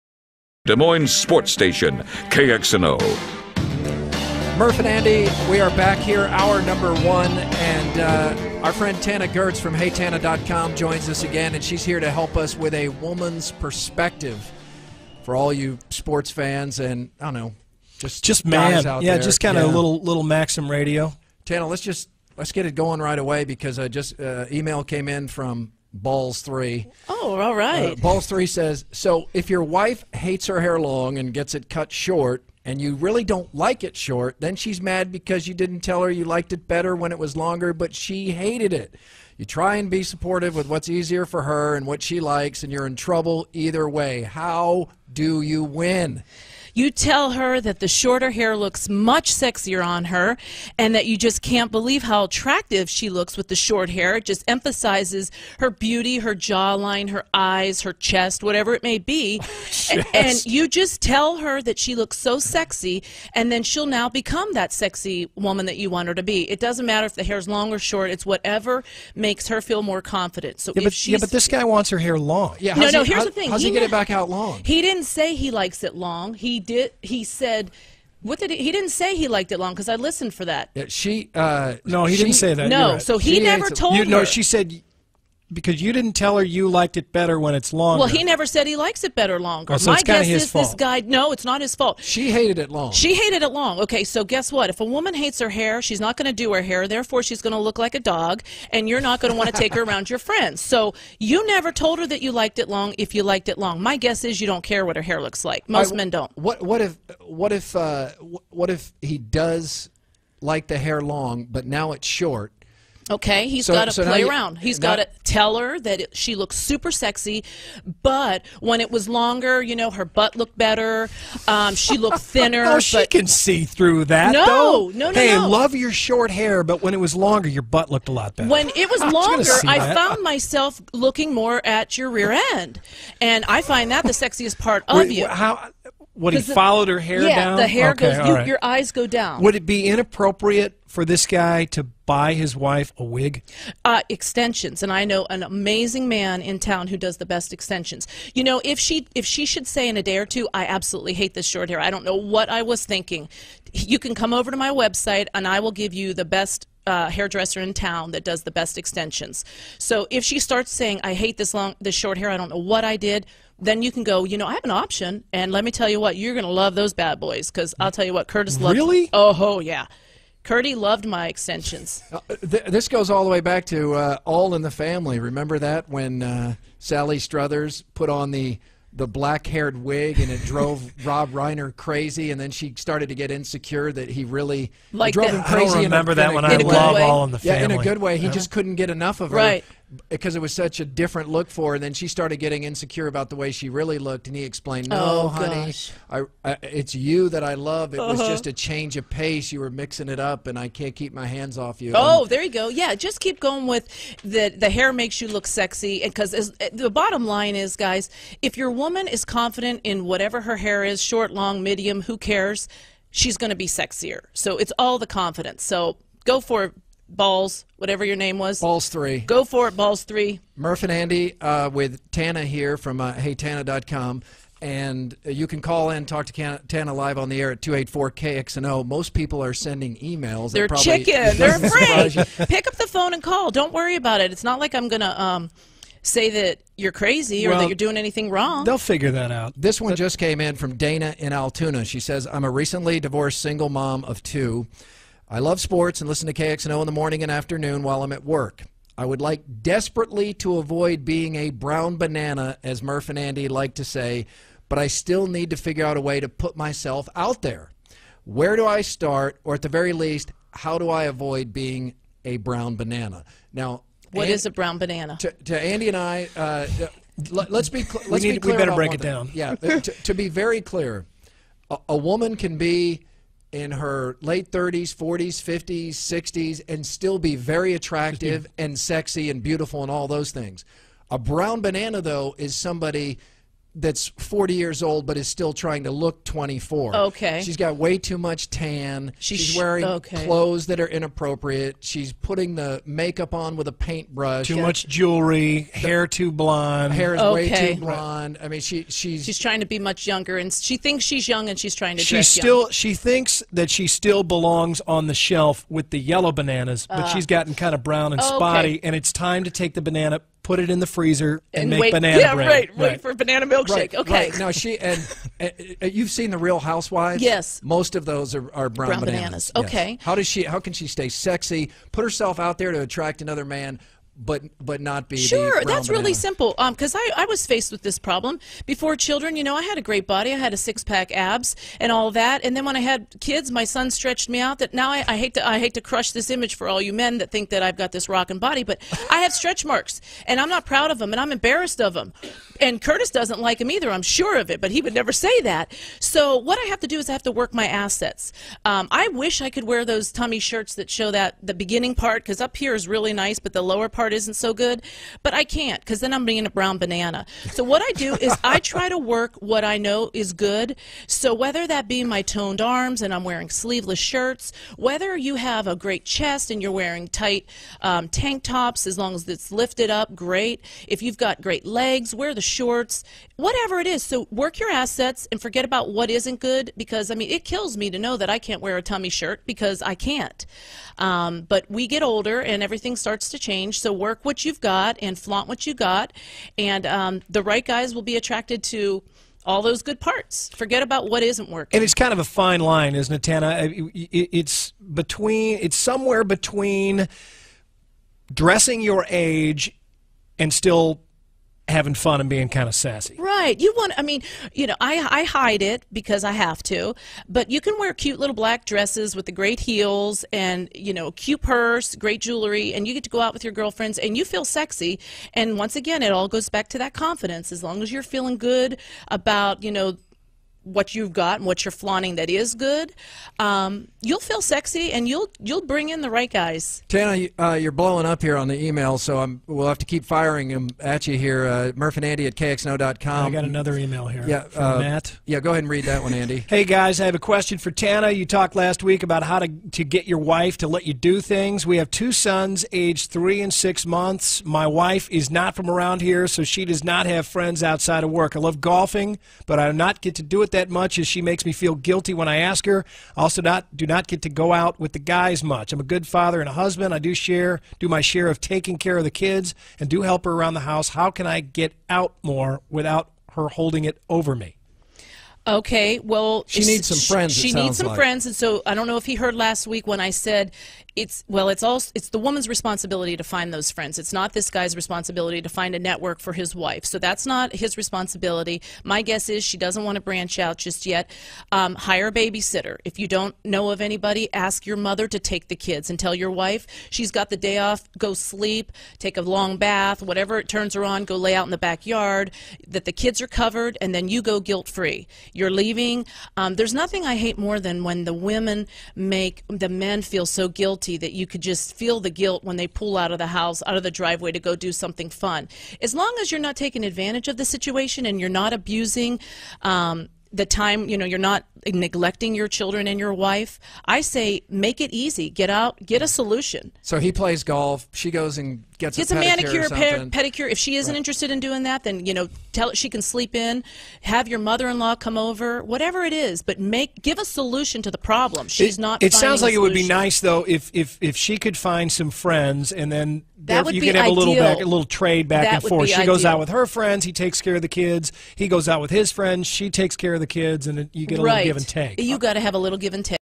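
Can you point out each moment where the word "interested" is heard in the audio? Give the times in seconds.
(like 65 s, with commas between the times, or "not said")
520 s.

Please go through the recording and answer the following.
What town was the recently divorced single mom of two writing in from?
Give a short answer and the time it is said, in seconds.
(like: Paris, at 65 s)
Altoona, at 241 s.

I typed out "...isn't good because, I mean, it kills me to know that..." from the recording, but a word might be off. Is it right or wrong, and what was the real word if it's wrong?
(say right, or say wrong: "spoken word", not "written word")
right.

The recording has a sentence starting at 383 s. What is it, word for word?
So work what you've got and flaunt what you got.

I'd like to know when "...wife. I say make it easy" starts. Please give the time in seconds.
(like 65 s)
513 s.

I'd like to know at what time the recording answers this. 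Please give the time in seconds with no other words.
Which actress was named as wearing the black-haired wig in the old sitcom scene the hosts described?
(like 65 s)
176 s.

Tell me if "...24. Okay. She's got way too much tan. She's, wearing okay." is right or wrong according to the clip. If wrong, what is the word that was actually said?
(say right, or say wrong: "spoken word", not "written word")
right.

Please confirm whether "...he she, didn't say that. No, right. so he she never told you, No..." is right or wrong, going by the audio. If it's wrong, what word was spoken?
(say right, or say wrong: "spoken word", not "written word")
right.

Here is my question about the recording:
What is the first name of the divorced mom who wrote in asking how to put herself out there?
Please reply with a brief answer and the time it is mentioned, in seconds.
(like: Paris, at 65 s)
Dana, at 240 s.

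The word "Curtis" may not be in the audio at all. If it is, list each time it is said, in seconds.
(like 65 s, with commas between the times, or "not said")
168 s, 342 s.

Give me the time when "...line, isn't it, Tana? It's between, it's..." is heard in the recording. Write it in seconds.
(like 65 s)
392 s.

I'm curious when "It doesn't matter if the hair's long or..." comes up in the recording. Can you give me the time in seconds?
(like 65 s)
66 s.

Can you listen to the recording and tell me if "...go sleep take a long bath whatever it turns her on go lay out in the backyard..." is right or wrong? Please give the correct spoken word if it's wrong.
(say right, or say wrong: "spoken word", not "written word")
right.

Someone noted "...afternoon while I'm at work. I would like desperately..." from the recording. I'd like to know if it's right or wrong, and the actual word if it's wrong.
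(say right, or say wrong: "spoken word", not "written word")
right.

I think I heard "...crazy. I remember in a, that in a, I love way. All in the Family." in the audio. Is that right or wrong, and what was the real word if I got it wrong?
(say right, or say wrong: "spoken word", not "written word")
right.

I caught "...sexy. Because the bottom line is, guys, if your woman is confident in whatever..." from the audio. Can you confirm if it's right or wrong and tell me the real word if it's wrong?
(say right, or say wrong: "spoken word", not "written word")
right.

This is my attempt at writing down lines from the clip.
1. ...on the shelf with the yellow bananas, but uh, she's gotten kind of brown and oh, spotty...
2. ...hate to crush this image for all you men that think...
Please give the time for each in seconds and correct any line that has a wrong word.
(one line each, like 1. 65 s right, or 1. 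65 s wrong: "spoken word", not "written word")
1. 304 s right
2. 335 s right.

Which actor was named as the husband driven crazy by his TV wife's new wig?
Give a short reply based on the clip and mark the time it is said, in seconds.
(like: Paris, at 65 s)
Rob Reiner, at 181 s.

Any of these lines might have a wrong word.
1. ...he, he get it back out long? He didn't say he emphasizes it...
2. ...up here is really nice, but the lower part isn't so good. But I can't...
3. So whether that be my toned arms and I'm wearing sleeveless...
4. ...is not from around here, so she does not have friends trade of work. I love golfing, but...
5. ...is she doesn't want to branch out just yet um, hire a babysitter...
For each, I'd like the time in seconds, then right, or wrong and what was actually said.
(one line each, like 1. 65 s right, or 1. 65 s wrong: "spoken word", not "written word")
1. 73 s wrong: "likes", not "emphasizes"
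2. 352 s right
3. 361 s right
4. 445 s wrong: "outside", not "trade"
5. 479 s right.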